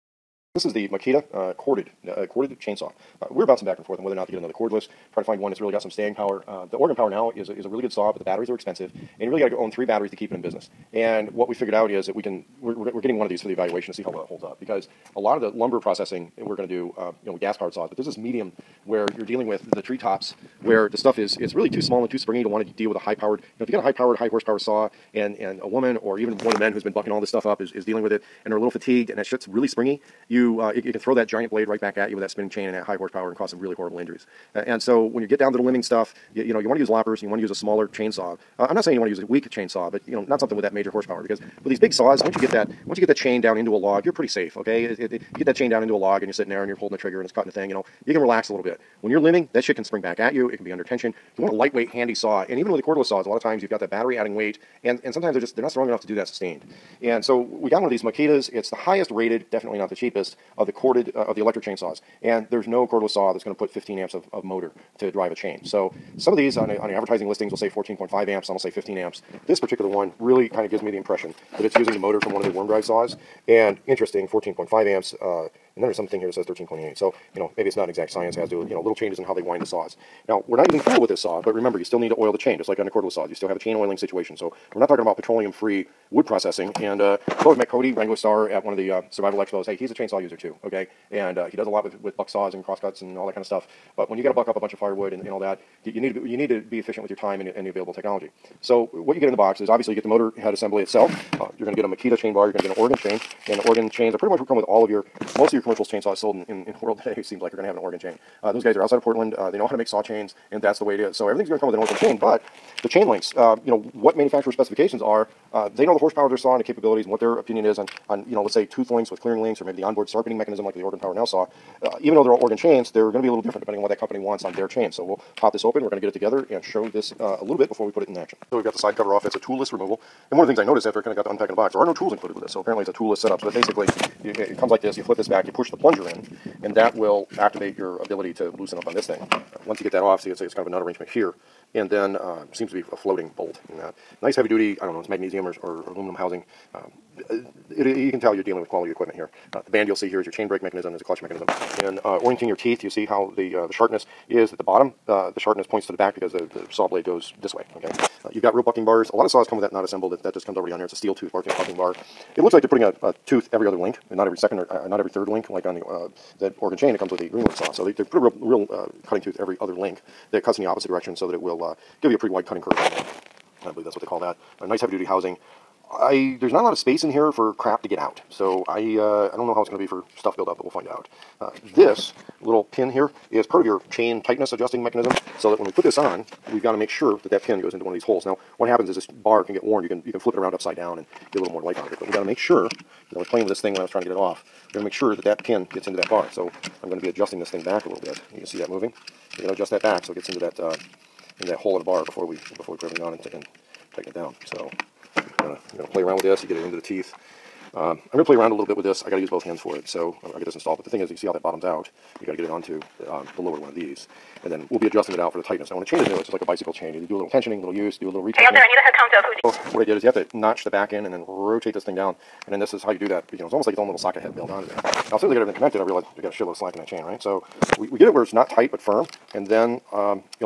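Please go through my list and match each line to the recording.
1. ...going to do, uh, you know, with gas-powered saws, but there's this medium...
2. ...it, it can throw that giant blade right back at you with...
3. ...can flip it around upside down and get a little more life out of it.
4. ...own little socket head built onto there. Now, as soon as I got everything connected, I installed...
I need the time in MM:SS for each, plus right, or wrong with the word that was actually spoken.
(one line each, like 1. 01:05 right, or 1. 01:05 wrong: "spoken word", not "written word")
1. 00:16 right
2. 00:30 right
3. 03:10 right
4. 03:43 wrong: "realized", not "installed".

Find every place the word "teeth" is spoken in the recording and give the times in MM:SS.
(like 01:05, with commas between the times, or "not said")
02:32, 03:26.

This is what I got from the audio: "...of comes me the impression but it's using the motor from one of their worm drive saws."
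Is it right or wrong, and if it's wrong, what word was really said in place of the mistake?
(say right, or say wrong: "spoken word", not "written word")
wrong: "gives", not "comes".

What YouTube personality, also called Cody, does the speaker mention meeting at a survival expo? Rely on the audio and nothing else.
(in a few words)
Wranglerstar.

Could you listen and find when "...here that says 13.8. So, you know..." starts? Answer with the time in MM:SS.
01:16.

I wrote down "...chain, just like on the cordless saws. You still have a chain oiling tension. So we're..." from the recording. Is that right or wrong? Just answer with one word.
wrong.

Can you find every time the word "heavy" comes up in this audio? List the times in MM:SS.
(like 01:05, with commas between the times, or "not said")
02:24, 02:54.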